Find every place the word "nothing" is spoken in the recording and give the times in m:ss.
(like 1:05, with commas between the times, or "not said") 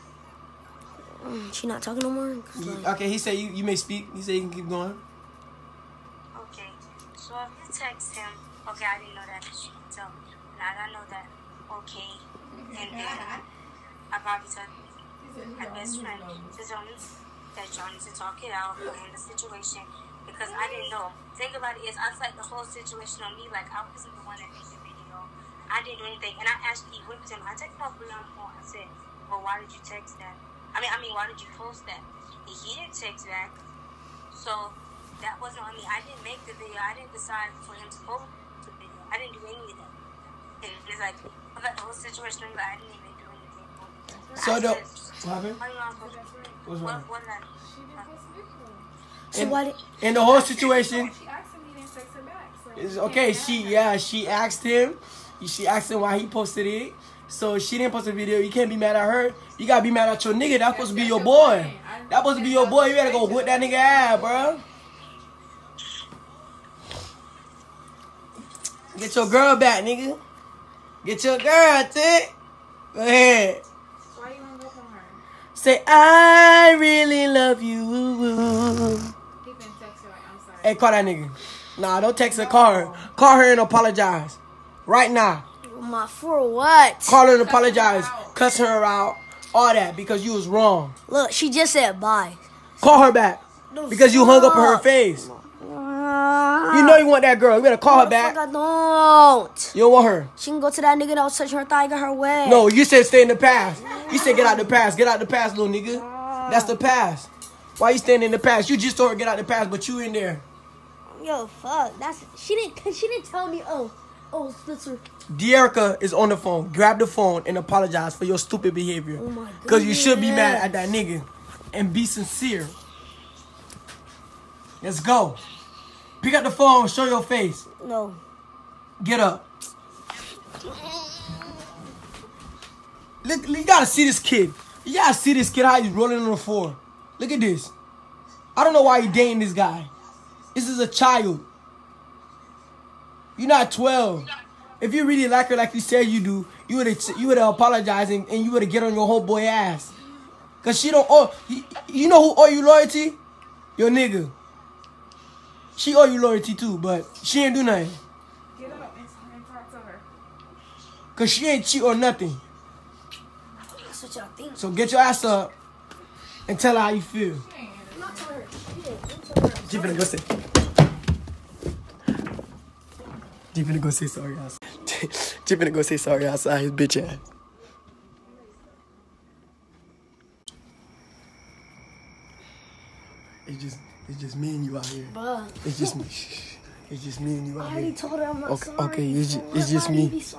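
2:37, 2:41.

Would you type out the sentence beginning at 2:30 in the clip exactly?
Cause she don't owe you, you know who owe you loyalty?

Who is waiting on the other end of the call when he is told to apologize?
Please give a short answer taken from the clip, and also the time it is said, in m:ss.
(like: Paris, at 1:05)
Dierica, at 1:55.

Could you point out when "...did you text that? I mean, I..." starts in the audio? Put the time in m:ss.
0:29.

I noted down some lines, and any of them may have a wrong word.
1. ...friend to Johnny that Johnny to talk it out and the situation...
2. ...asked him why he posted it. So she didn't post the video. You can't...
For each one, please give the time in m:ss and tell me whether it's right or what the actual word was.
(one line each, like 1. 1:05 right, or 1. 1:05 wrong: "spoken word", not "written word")
1. 0:16 right
2. 0:55 right.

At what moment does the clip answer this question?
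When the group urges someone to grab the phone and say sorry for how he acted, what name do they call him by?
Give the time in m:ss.
1:54.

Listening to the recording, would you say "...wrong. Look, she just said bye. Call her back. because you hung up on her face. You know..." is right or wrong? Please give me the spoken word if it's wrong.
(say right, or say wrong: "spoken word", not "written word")
right.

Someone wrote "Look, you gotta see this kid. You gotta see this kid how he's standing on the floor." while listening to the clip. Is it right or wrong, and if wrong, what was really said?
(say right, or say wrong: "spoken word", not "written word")
wrong: "rolling", not "standing".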